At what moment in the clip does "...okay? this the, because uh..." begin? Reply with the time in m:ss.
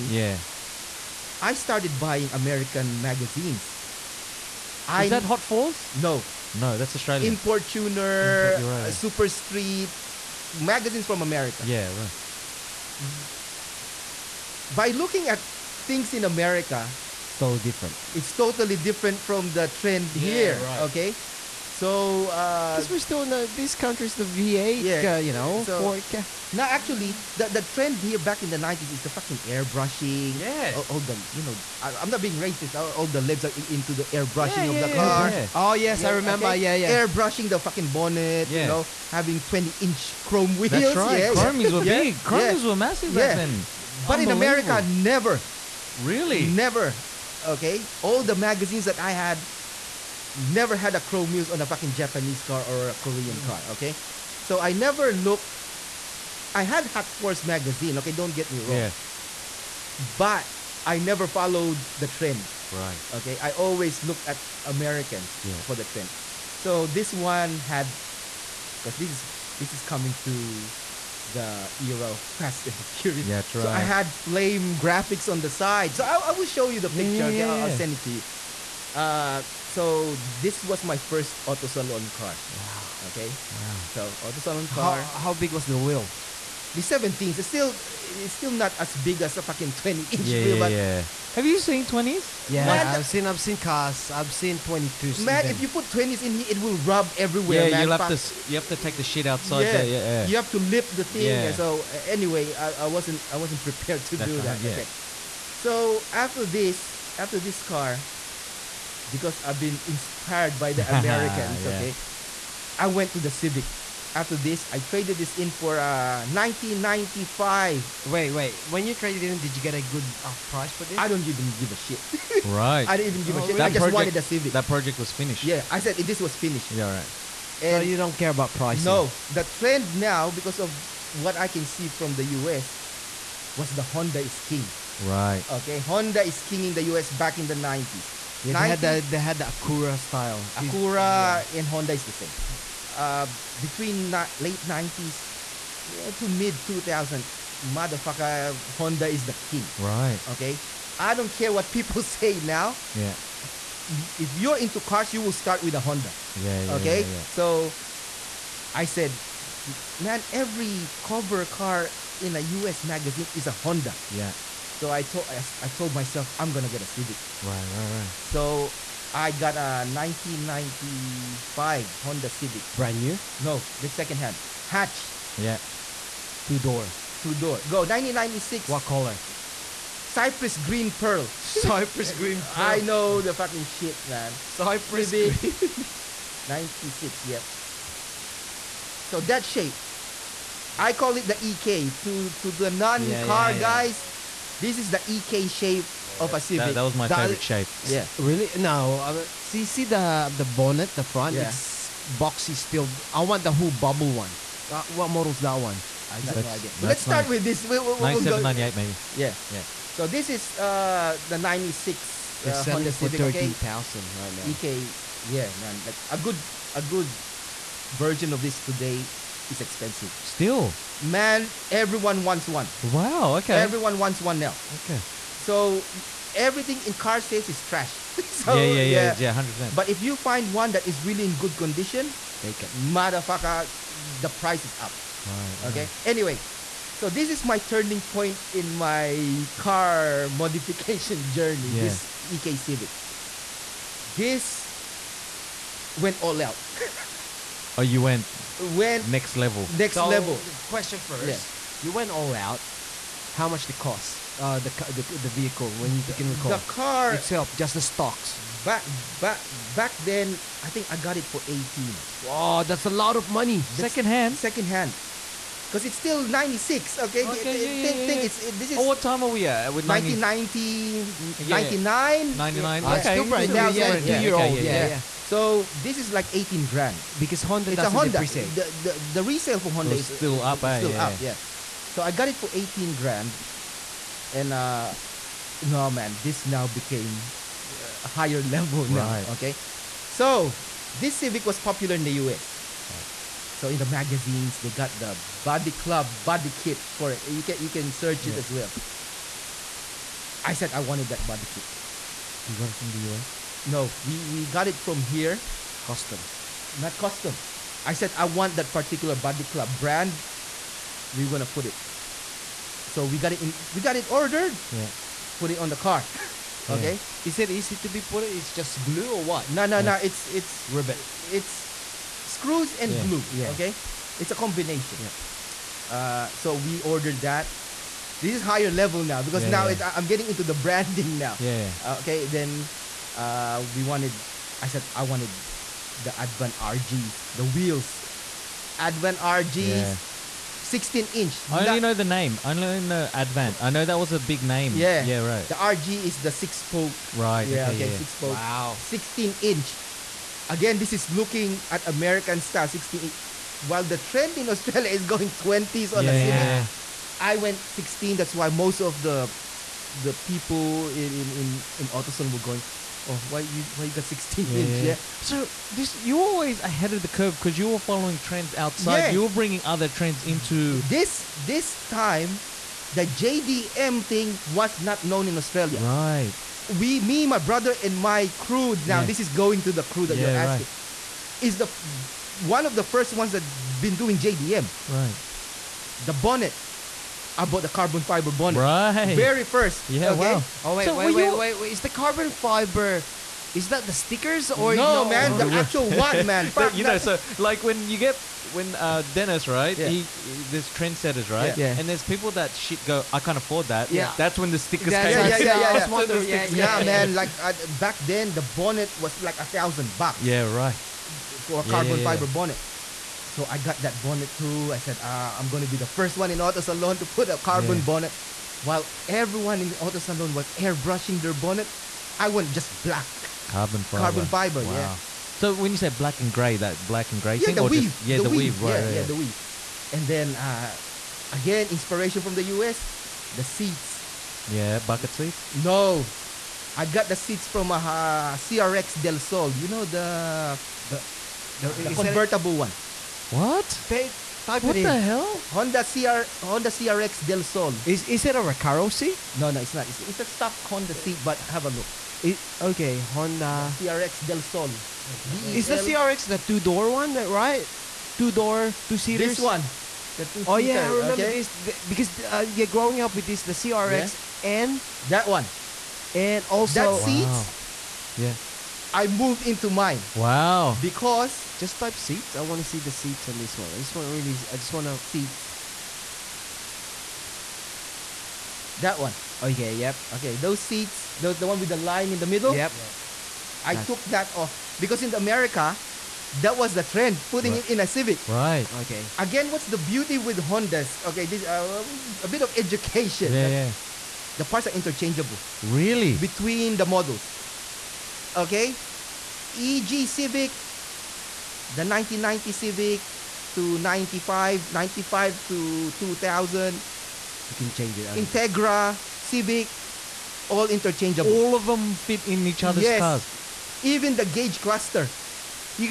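7:41.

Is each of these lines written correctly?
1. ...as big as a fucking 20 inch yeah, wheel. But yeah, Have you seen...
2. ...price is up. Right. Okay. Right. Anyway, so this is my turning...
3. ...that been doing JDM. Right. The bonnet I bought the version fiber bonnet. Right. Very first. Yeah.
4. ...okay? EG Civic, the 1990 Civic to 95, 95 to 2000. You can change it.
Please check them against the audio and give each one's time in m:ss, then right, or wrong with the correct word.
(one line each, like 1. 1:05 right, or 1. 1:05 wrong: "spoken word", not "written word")
1. 1:28 right
2. 3:54 right
3. 6:23 wrong: "carbon", not "version"
4. 8:18 right.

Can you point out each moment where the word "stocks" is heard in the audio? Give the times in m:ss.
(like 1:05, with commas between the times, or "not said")
4:17, 7:30.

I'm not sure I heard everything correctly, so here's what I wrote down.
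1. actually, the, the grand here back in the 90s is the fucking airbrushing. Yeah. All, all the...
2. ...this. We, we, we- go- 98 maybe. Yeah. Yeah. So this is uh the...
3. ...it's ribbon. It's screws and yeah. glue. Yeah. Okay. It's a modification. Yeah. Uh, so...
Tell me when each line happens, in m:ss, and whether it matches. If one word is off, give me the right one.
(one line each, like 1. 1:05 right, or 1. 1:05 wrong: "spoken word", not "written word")
1. 0:26 wrong: "trend", not "grand"
2. 3:27 right
3. 5:20 wrong: "combination", not "modification".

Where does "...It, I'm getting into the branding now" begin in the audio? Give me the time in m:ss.
5:29.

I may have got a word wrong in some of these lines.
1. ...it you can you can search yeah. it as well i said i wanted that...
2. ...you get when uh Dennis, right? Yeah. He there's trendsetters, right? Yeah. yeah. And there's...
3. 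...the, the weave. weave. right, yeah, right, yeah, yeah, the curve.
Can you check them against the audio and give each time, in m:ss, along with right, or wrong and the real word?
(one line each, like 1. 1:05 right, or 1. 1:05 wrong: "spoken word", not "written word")
1. 4:57 right
2. 6:37 right
3. 7:08 wrong: "weave", not "curve".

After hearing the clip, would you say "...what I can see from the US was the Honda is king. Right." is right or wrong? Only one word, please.
right.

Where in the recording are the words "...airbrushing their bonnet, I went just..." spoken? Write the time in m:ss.
7:00.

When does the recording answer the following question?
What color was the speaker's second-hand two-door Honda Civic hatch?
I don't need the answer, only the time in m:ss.
3:00.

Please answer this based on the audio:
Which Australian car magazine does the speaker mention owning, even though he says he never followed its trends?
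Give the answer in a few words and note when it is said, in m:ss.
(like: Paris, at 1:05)
Hot4s, at 0:56.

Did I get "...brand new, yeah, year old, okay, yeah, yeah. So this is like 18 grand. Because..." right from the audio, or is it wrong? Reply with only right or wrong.
right.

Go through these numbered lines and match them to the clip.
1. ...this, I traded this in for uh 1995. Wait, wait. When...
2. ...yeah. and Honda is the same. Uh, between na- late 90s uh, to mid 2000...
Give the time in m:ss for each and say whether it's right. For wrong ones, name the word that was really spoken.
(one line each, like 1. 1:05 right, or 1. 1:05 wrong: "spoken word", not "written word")
1. 1:54 right
2. 2:21 right.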